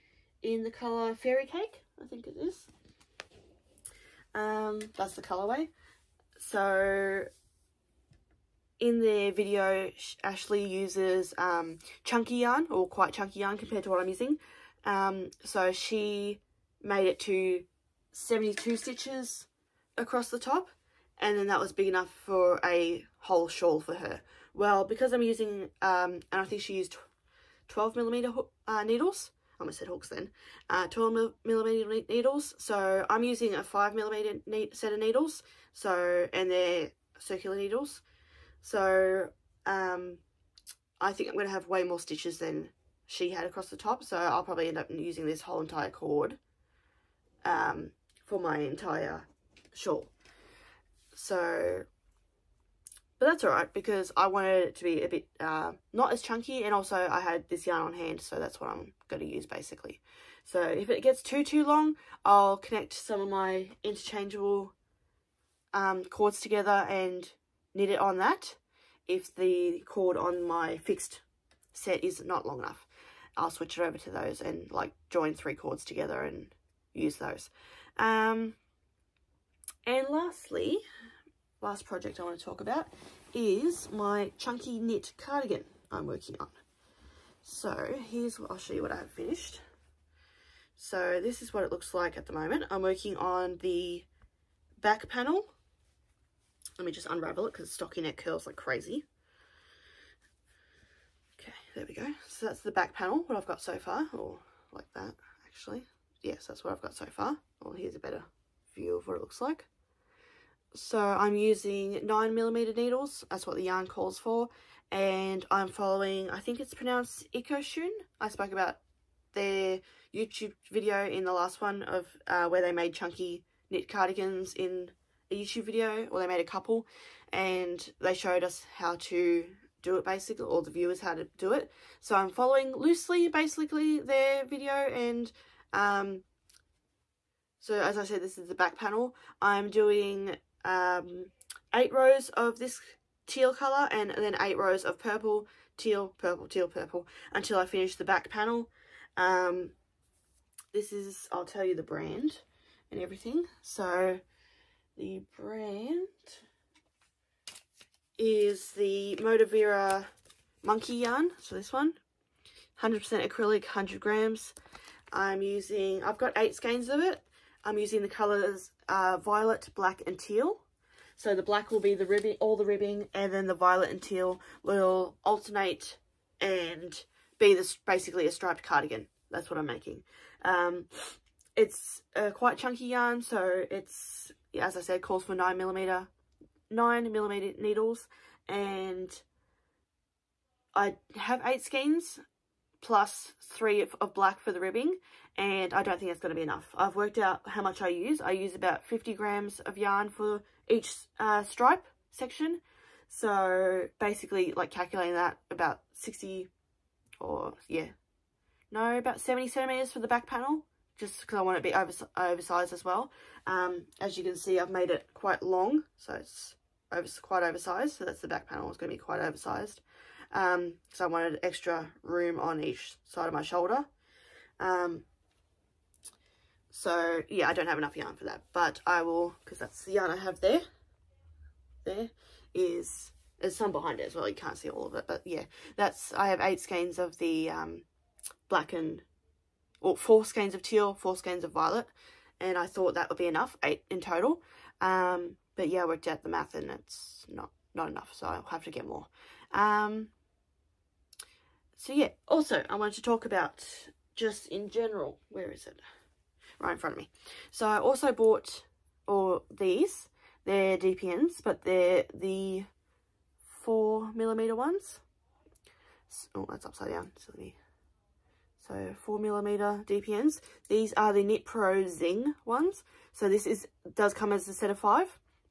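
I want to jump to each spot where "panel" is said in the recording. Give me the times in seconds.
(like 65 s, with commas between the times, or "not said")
95 s, 102 s, 138 s, 148 s, 210 s, 218 s.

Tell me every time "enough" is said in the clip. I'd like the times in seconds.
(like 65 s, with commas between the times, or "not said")
21 s, 72 s, 196 s, 227 s, 243 s, 247 s.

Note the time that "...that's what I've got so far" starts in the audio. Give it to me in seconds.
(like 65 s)
106 s.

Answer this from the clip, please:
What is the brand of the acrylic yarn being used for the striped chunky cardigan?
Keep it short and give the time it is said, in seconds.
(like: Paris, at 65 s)
Moda Vera Monkey Yarn, at 159 s.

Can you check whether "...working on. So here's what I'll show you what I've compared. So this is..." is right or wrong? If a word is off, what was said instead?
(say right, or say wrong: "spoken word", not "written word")
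wrong: "finished", not "compared".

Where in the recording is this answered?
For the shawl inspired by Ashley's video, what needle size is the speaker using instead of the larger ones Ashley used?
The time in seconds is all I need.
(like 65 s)
33 s.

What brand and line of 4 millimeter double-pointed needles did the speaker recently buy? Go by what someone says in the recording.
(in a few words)
Knit Pro Zing.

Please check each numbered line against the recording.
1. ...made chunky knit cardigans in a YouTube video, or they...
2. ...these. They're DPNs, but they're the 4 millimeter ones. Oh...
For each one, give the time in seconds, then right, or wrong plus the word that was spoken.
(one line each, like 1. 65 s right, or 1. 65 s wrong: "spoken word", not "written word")
1. 122 s right
2. 259 s right.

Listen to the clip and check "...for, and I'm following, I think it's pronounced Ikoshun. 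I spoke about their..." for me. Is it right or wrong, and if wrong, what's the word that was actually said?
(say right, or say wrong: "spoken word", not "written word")
right.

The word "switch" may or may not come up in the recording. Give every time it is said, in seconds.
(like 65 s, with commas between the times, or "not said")
73 s.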